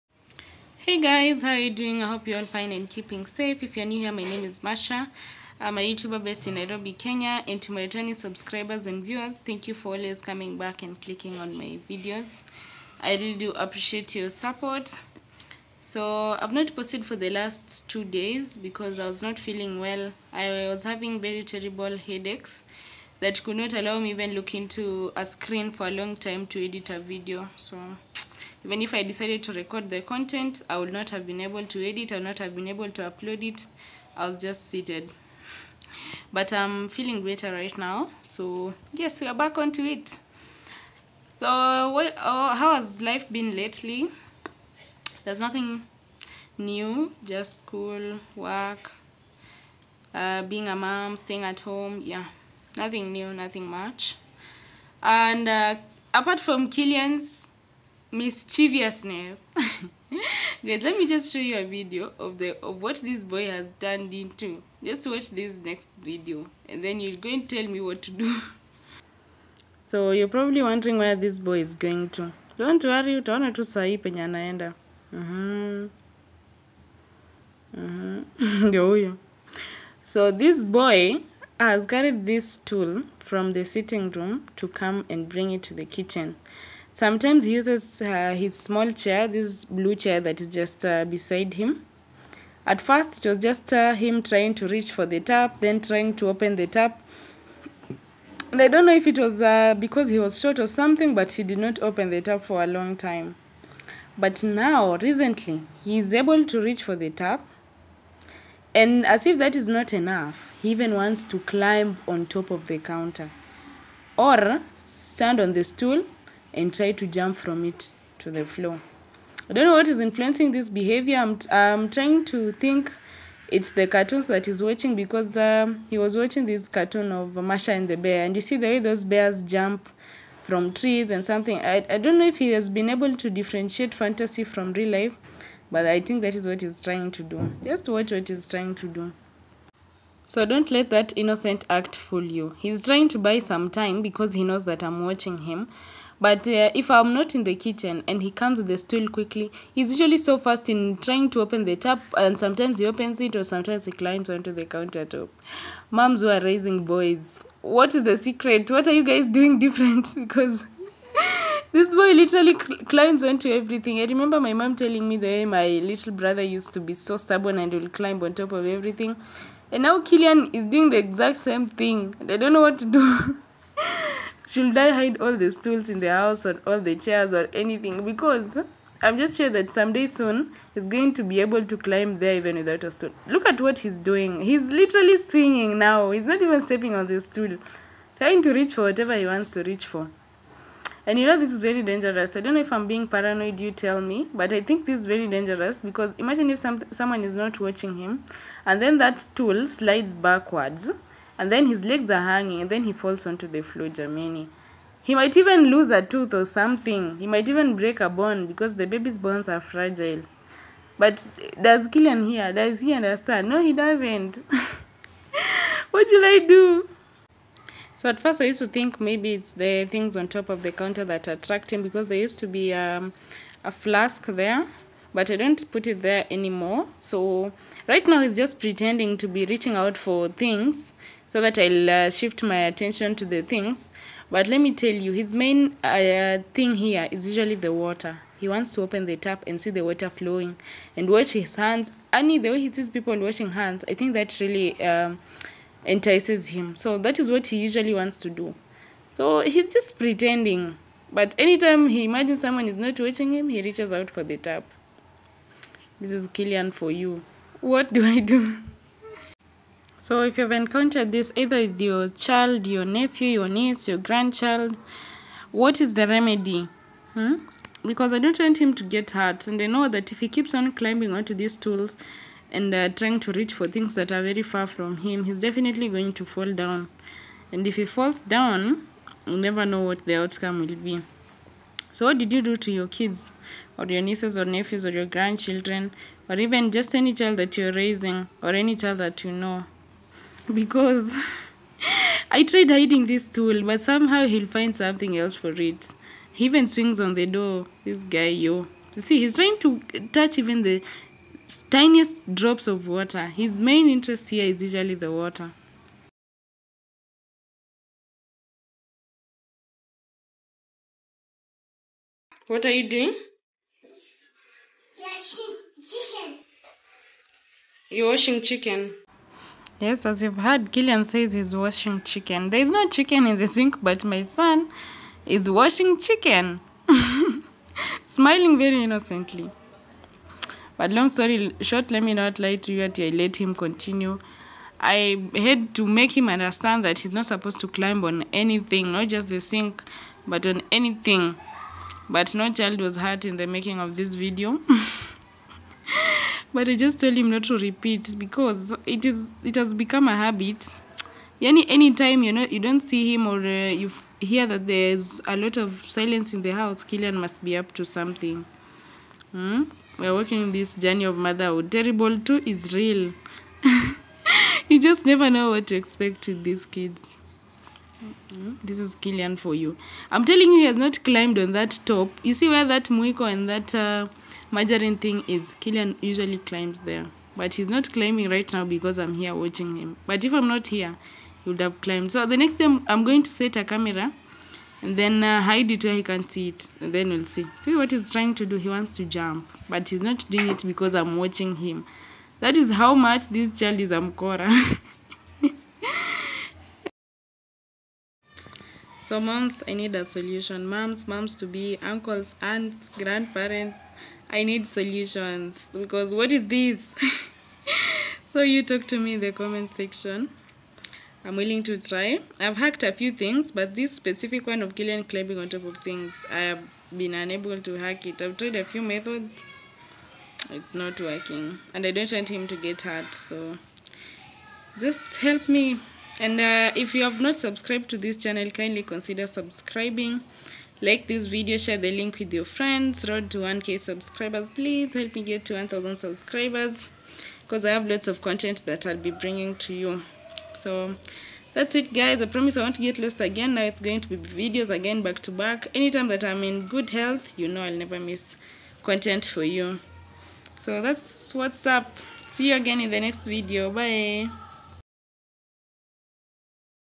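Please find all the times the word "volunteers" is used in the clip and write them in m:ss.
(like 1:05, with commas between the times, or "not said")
not said.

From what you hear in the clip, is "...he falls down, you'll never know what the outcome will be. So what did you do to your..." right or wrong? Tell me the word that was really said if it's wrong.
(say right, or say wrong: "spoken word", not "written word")
right.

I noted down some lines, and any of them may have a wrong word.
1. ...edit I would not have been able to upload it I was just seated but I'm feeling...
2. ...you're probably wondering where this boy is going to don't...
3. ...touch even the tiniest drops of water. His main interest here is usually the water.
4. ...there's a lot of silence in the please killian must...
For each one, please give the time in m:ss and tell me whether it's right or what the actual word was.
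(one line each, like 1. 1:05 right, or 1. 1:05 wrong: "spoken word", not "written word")
1. 0:31 right
2. 1:10 right
3. 5:00 right
4. 5:54 wrong: "house", not "please".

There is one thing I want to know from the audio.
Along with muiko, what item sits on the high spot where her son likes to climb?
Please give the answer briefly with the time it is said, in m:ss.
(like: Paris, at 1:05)
Margarine, at 6:14.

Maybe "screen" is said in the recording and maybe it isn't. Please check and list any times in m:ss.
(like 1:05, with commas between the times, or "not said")
0:25.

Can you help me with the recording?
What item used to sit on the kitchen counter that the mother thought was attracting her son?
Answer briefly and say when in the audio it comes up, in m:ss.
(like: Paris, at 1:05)
A flask, at 3:43.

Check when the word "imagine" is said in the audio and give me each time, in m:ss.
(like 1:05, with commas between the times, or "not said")
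3:16, 4:12.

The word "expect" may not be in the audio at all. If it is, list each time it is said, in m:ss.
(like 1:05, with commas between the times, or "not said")
6:05.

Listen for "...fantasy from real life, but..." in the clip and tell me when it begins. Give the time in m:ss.
2:13.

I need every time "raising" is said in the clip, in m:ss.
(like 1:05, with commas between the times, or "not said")
2:36, 4:47.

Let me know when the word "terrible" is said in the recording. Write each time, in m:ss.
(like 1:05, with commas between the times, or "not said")
0:21, 6:01.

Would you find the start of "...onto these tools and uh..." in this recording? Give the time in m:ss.
4:31.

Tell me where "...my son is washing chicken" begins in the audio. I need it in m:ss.
5:24.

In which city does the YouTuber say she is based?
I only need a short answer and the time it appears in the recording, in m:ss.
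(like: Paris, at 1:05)
Nairobi, at 0:06.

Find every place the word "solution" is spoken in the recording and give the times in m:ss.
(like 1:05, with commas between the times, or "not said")
6:40, 6:44.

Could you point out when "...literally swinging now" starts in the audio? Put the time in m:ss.
3:04.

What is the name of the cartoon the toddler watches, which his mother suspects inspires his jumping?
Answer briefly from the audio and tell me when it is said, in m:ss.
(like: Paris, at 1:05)
Masha and the Bear, at 2:07.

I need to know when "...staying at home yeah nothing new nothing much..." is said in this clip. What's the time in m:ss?
0:51.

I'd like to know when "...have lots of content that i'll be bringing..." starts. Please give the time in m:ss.
7:17.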